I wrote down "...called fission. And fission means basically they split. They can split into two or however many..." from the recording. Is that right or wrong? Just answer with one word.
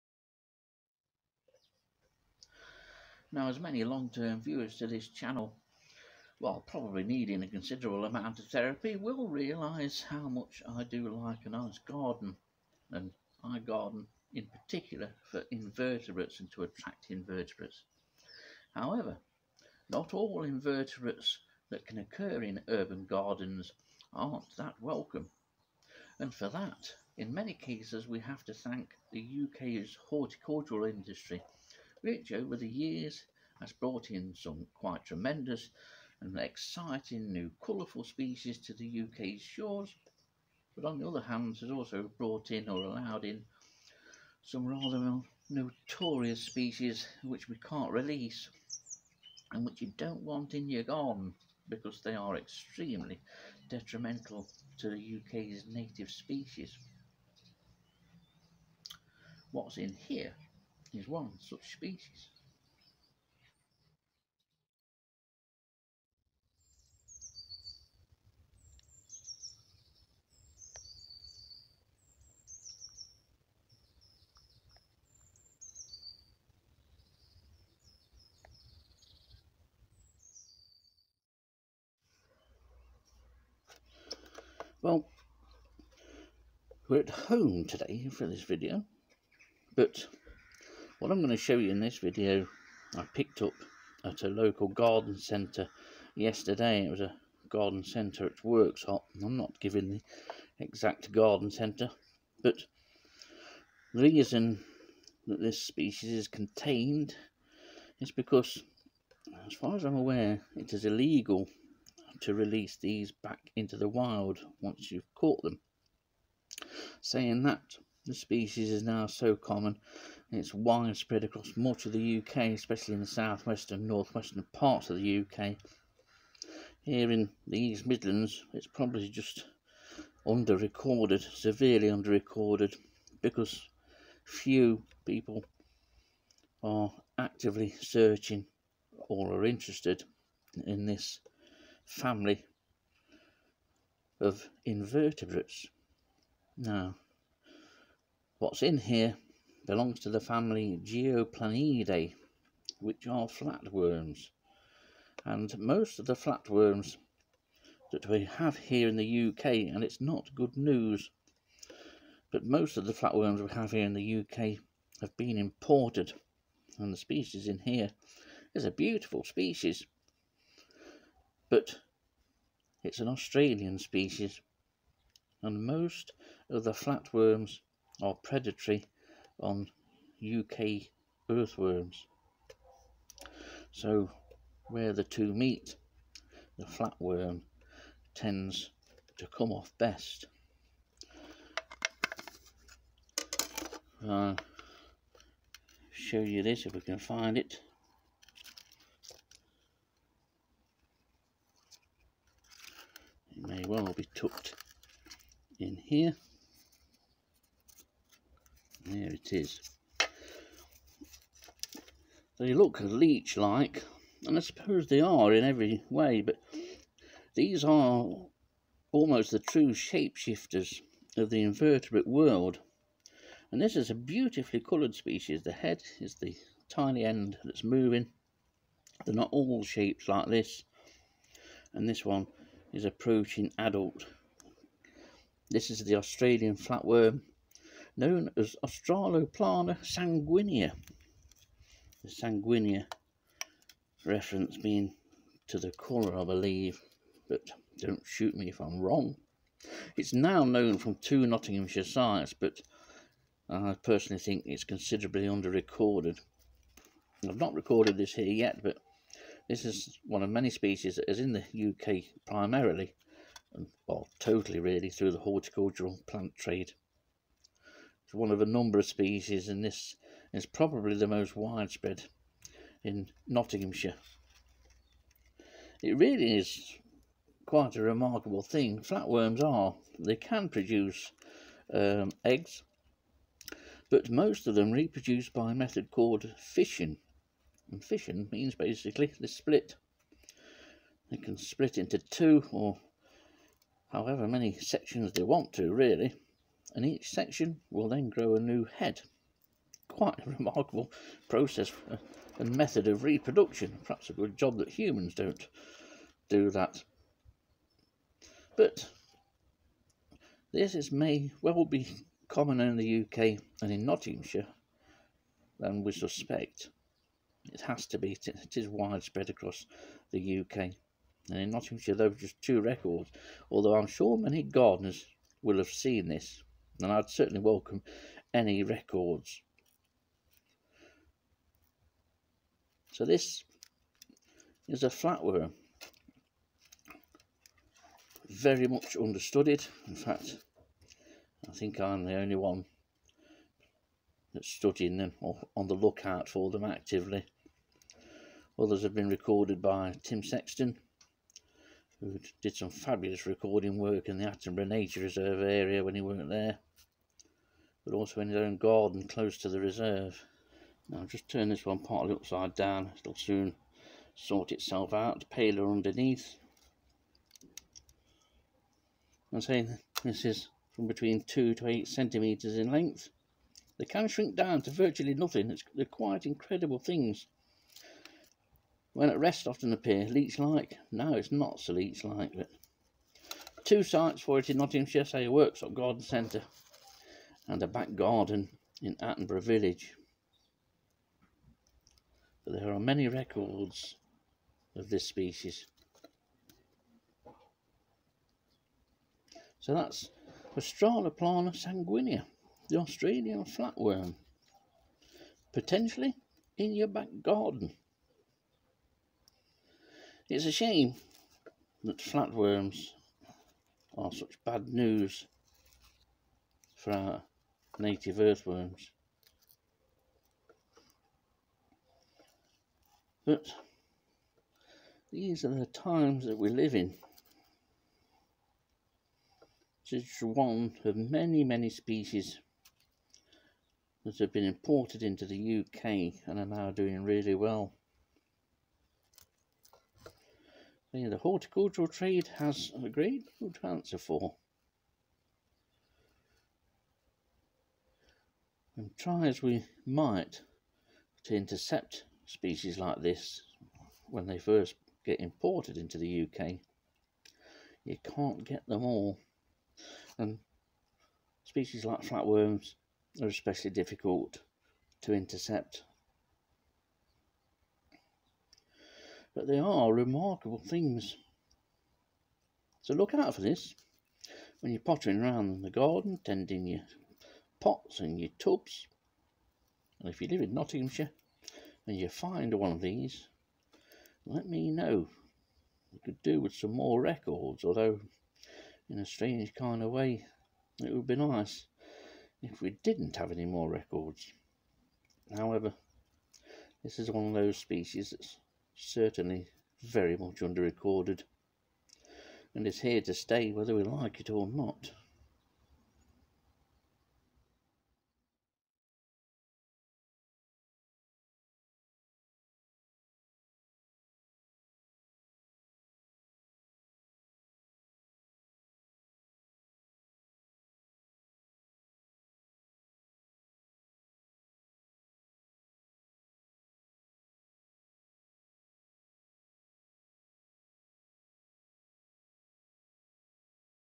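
right.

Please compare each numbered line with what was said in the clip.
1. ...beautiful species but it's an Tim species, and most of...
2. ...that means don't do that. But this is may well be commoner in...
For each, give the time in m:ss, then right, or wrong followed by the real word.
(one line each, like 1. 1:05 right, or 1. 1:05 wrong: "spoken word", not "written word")
1. 2:48 wrong: "Australian", not "Tim"
2. 5:04 wrong: "humans", not "means".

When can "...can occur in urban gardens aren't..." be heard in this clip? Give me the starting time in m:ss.
0:21.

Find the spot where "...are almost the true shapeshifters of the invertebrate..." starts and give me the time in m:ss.
3:37.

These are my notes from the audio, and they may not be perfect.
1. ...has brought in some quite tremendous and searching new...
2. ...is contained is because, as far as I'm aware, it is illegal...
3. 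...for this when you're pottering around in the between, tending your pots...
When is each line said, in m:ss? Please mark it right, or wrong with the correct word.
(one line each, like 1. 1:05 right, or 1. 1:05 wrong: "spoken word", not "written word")
1. 0:33 wrong: "exciting", not "searching"
2. 1:46 right
3. 7:53 wrong: "garden", not "between".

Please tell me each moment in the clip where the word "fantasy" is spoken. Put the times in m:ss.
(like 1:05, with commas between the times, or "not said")
not said.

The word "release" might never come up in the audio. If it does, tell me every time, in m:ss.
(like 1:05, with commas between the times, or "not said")
0:47, 1:52.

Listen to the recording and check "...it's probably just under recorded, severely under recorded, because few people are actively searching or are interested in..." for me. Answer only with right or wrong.
right.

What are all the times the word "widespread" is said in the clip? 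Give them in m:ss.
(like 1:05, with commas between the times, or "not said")
2:00, 4:31, 5:18.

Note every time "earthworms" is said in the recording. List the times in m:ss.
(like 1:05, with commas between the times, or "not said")
3:01, 6:58.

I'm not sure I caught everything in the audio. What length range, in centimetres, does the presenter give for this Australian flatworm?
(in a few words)
2 to 8 centimetres.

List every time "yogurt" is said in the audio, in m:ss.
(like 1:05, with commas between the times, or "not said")
not said.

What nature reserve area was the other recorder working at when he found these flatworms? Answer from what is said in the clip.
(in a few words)
Attenborough Nature Reserve.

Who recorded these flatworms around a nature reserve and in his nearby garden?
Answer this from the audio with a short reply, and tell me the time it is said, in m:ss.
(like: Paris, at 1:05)
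Tim Sexton, at 5:50.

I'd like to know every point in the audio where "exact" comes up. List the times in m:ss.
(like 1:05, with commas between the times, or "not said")
1:40.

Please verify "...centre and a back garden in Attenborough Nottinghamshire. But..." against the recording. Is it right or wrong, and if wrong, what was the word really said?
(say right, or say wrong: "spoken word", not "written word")
wrong: "Village", not "Nottinghamshire".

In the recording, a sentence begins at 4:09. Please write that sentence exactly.
It's now known from two Nottinghamshire sites, but I personally think it's considerably under-recorded.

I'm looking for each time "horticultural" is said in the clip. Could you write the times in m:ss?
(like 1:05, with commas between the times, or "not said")
0:30, 4:25, 7:21.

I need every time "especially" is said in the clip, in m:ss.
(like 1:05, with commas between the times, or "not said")
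2:02, 7:43.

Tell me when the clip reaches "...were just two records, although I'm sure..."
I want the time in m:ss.
5:22.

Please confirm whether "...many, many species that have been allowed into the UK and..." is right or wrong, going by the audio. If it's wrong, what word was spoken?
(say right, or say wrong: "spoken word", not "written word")
wrong: "imported", not "allowed".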